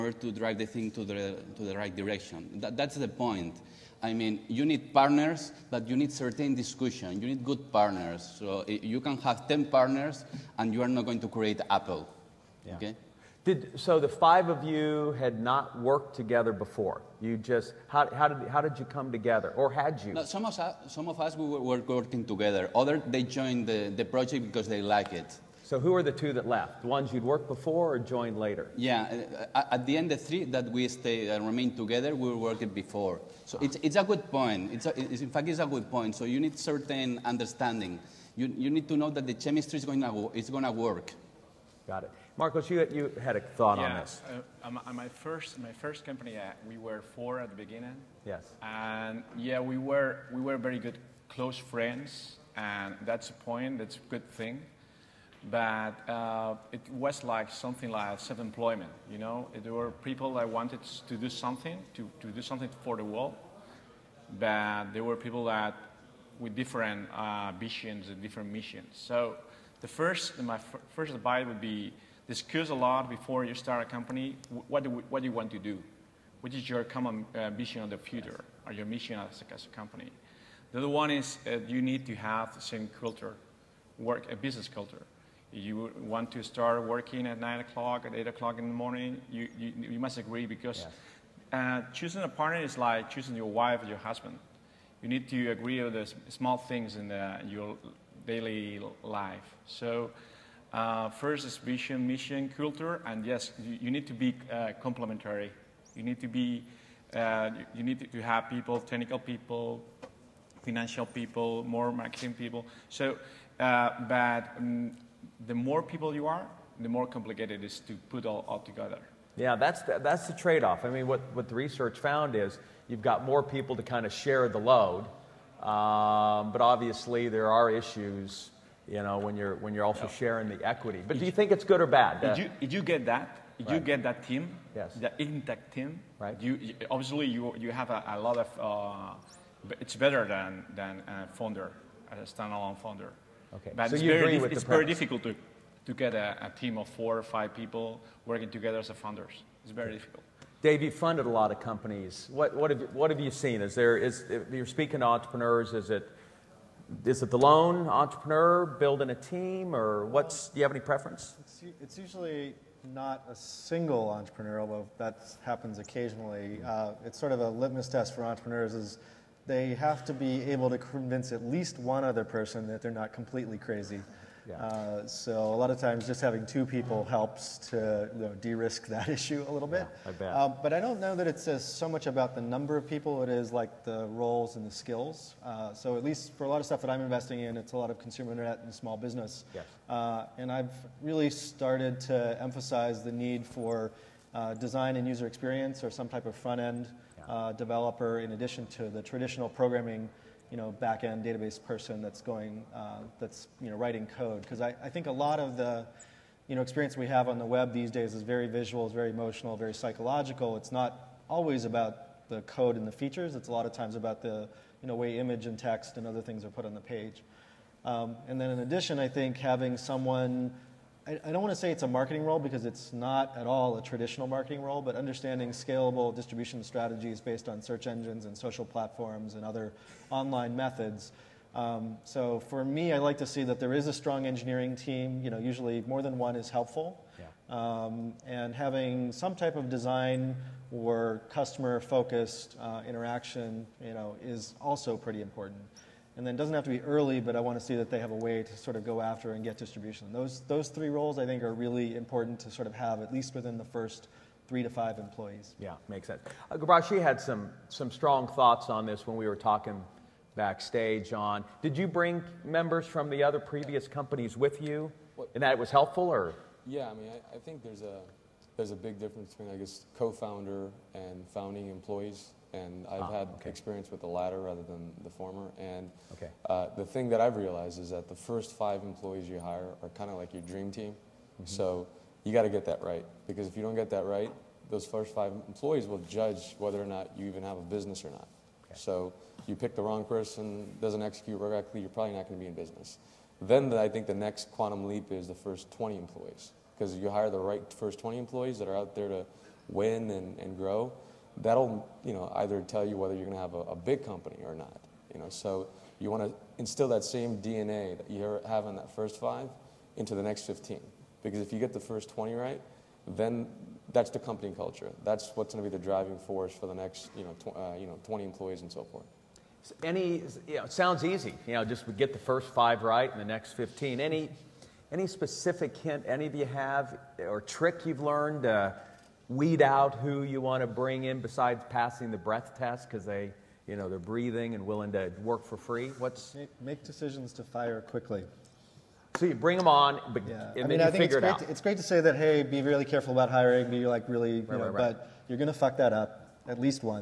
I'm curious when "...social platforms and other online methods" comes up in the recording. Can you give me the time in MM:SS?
03:48.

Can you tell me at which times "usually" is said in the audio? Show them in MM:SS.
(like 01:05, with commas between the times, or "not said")
02:41, 03:55.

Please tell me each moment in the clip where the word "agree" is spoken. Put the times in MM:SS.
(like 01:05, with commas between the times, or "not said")
01:30, 01:35.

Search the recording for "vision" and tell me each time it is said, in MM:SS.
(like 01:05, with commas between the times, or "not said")
01:07, 01:17, 01:41.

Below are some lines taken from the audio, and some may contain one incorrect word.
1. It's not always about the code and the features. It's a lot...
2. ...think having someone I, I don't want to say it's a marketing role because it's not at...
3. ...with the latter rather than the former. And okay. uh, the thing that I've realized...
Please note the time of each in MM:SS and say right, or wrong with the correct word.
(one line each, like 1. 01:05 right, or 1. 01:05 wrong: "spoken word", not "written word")
1. 03:30 right
2. 03:39 right
3. 04:33 right.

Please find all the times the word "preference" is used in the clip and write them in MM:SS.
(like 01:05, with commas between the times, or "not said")
02:40.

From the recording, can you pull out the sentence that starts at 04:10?
Those, those three roles I think are really important to sort of have at least within the first three to five employees.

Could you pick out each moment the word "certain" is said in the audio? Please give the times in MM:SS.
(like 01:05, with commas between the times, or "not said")
00:06, 00:36.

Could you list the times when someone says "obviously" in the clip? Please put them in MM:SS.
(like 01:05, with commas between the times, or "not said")
02:06, 02:16.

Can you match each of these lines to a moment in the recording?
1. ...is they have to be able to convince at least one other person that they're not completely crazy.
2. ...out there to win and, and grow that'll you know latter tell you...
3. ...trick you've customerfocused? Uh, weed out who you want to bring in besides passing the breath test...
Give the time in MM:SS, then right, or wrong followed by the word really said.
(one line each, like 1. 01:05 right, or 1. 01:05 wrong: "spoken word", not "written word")
1. 02:48 right
2. 04:58 wrong: "either", not "latter"
3. 05:27 wrong: "learned", not "customerfocused".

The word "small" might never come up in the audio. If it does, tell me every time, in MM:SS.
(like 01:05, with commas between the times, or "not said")
01:36, 03:08.